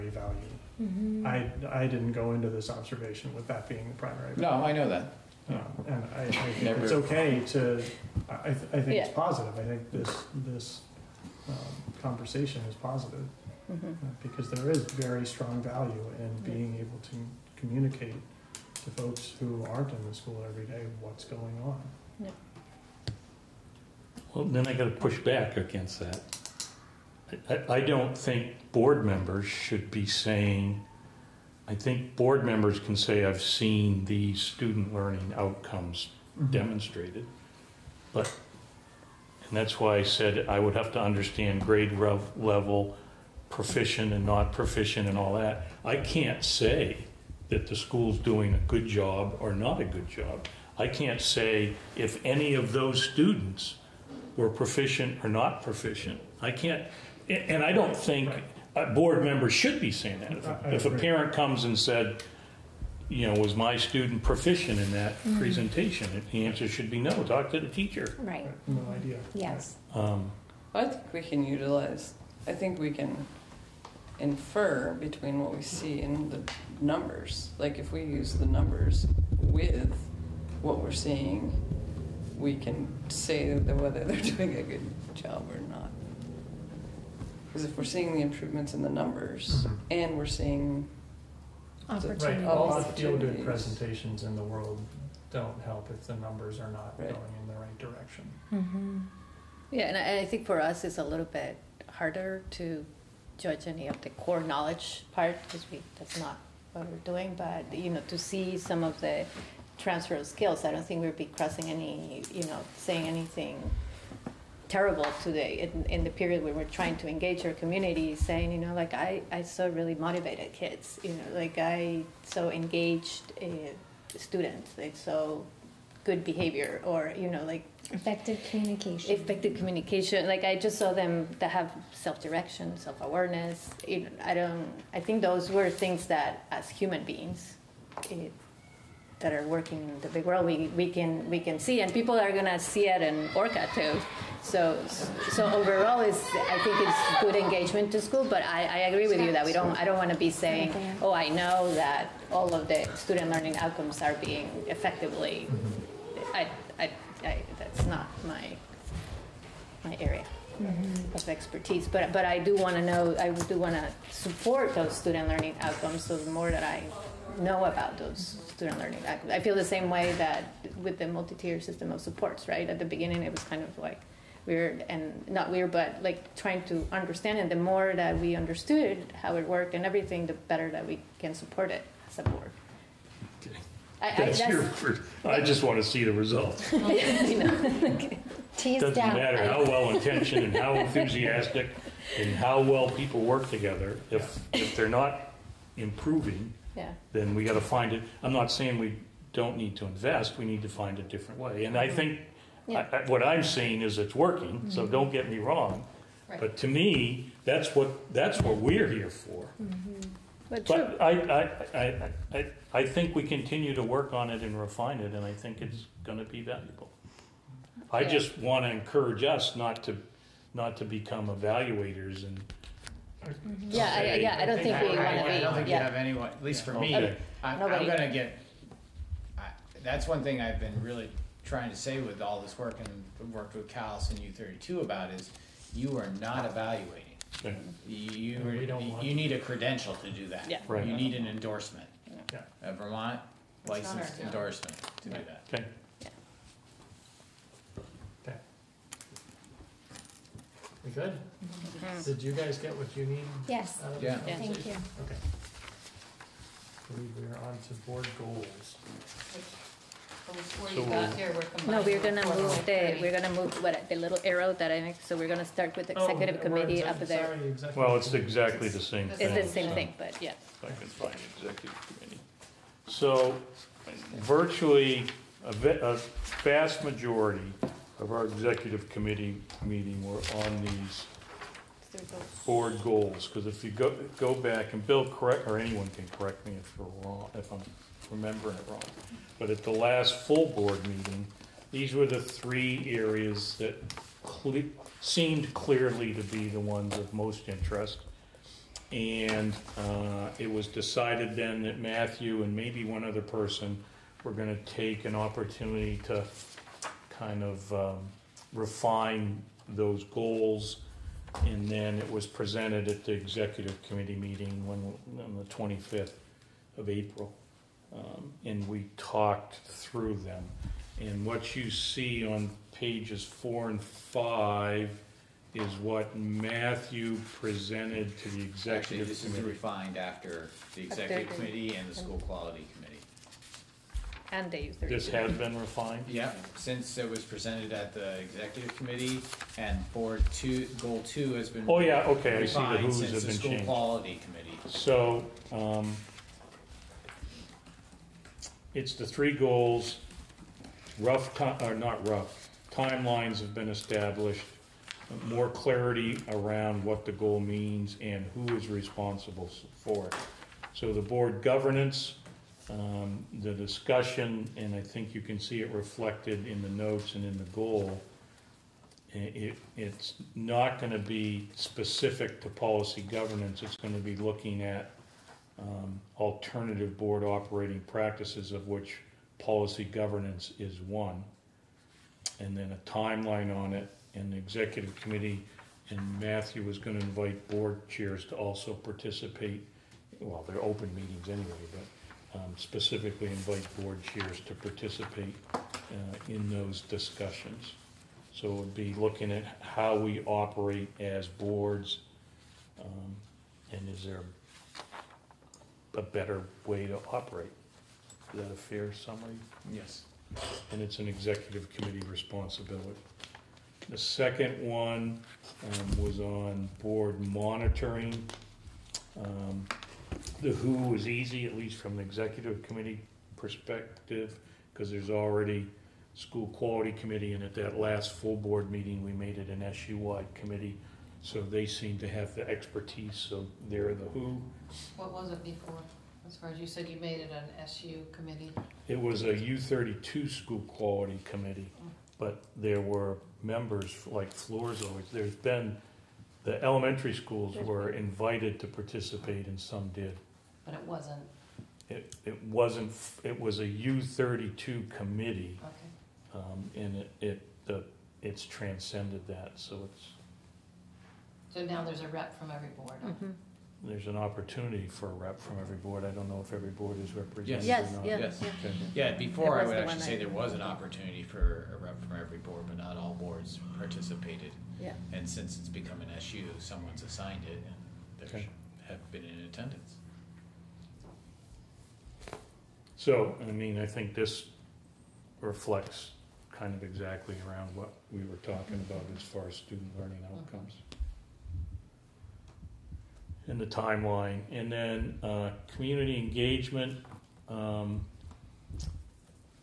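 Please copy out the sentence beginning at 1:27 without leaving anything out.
Because if we're seeing the improvements in the numbers Mhm.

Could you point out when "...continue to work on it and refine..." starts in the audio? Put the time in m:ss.
3:33.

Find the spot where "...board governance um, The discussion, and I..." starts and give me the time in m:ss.
6:01.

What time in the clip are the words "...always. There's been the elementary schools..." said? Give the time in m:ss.
7:24.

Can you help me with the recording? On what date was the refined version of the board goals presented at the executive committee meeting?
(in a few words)
April 25.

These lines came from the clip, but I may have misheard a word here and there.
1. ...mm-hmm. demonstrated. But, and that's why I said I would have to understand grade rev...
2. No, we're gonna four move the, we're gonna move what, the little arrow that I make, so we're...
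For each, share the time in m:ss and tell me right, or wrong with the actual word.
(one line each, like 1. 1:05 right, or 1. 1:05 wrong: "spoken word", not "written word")
1. 0:36 right
2. 4:21 right.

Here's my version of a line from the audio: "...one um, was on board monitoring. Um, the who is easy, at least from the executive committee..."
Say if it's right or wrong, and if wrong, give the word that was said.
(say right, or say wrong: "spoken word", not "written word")
right.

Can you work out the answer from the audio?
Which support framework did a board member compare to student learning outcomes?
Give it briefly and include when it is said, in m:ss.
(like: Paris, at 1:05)
Multi-tier system of supports, at 2:51.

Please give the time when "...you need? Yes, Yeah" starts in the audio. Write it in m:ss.
4:12.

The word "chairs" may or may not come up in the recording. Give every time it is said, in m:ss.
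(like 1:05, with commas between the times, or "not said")
6:27, 6:34.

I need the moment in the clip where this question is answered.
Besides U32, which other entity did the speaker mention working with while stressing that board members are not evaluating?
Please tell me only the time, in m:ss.
3:53.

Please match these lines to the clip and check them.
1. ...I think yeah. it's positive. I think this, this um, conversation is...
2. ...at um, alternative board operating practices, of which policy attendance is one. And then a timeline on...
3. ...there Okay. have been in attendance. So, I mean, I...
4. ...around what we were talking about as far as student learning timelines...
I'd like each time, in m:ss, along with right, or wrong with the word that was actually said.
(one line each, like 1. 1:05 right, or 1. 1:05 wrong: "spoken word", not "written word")
1. 0:08 right
2. 6:14 wrong: "governance", not "attendance"
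3. 7:58 right
4. 8:07 wrong: "outcomes", not "timelines".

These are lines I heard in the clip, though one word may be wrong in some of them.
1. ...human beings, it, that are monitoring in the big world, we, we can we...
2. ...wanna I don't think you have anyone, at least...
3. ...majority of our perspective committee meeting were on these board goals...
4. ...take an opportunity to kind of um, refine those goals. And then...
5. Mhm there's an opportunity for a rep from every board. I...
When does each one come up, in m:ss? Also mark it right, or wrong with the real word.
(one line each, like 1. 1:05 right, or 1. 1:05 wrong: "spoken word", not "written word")
1. 2:16 wrong: "working", not "monitoring"
2. 3:44 right
3. 4:36 wrong: "executive", not "perspective"
4. 5:04 right
5. 7:43 right.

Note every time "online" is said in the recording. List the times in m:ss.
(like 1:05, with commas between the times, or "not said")
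not said.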